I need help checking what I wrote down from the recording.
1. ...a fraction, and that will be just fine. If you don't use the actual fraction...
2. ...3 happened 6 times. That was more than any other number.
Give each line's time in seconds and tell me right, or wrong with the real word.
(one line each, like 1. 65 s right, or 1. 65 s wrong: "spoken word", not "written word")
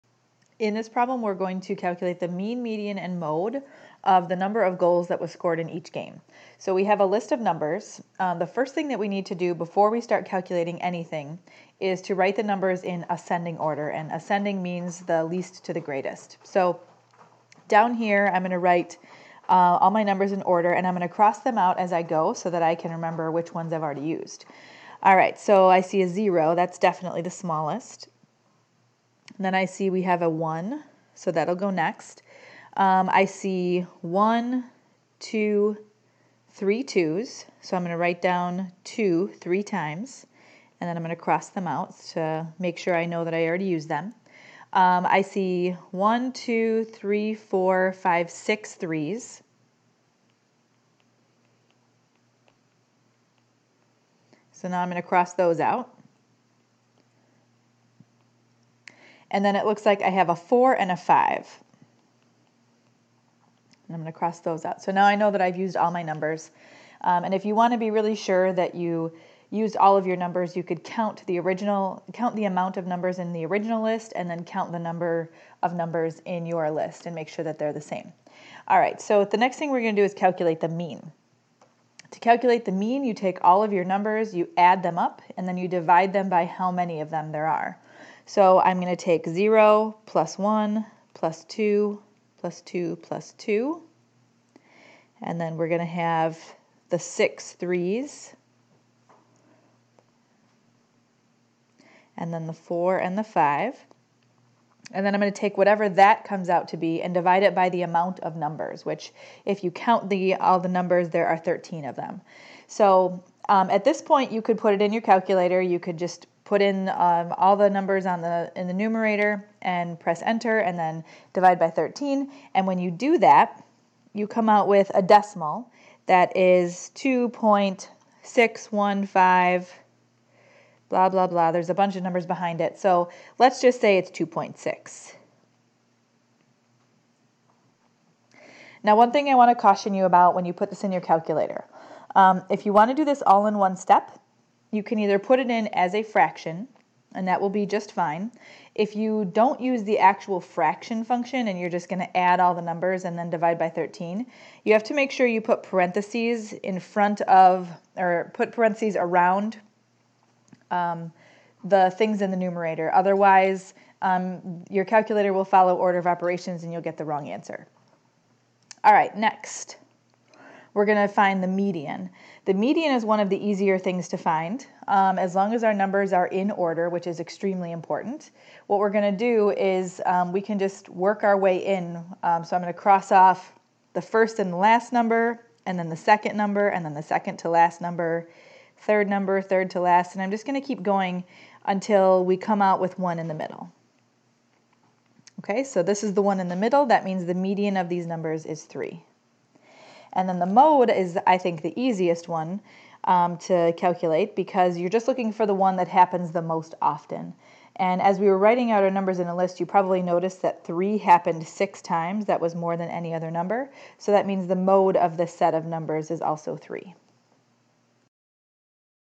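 1. 145 s right
2. 210 s right.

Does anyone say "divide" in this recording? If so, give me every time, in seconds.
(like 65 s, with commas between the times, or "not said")
85 s, 107 s, 121 s, 153 s.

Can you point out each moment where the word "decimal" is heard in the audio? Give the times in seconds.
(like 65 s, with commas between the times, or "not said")
125 s.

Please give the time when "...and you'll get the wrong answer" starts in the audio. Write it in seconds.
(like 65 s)
166 s.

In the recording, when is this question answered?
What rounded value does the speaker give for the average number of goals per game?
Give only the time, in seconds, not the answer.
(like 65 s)
134 s.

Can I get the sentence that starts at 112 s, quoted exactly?
So um, at this point, you could put it in your calculator.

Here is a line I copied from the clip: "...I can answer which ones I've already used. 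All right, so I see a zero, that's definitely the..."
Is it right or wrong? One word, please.
wrong.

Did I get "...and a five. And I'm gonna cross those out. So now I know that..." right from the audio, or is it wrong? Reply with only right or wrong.
right.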